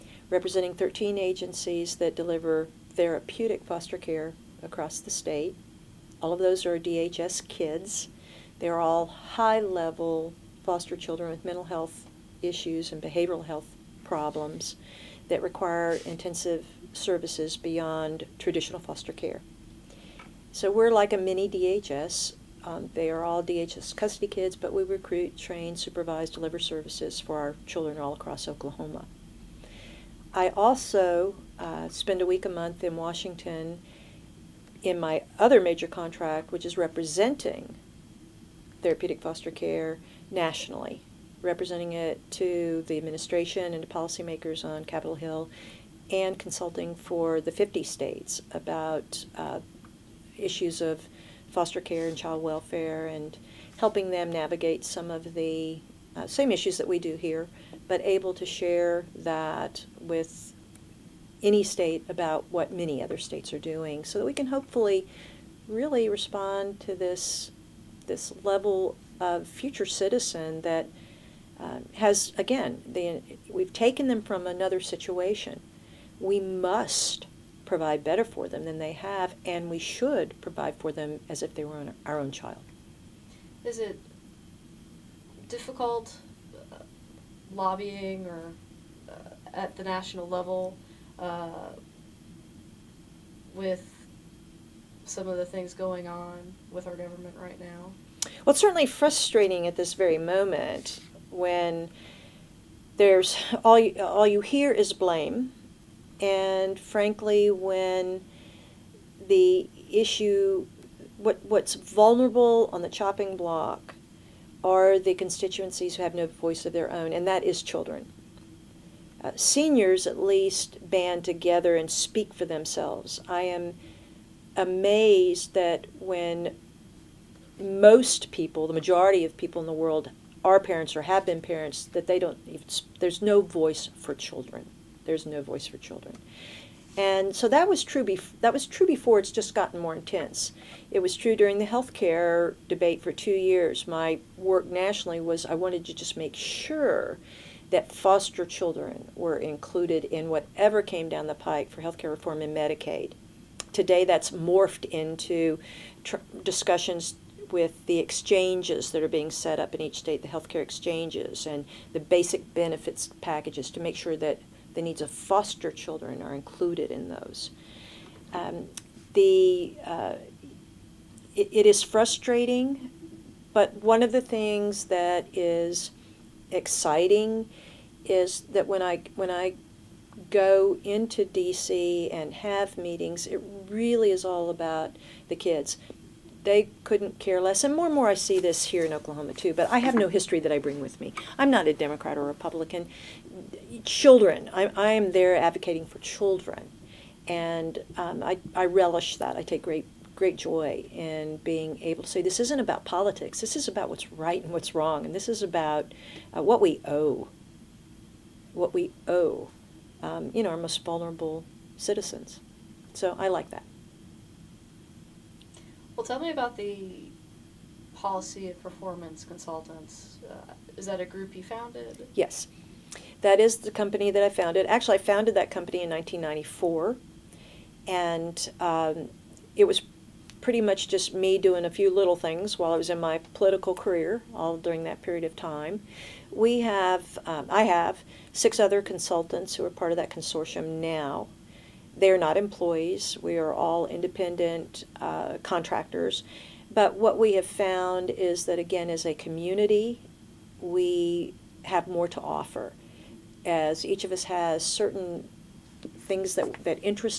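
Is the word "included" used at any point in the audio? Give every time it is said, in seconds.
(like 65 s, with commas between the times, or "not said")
149 s, 166 s.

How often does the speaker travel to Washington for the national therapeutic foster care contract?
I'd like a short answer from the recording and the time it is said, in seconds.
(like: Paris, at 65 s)
a week a month, at 32 s.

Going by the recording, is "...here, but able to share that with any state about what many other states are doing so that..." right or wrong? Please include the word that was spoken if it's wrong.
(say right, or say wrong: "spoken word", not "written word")
right.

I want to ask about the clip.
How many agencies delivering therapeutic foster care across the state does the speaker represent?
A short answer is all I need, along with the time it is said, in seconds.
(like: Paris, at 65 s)
13, at 0 s.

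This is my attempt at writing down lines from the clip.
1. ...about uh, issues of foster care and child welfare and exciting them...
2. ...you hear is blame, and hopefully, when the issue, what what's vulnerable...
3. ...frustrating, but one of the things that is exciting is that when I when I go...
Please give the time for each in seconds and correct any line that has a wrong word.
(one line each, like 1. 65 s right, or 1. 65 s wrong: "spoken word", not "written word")
1. 48 s wrong: "helping", not "exciting"
2. 104 s wrong: "frankly", not "hopefully"
3. 171 s right.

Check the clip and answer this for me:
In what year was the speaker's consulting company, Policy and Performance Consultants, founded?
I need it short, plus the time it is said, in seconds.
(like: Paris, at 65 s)
1994, at 225 s.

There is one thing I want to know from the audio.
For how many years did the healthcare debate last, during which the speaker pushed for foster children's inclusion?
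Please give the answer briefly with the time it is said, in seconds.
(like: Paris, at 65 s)
2 years, at 143 s.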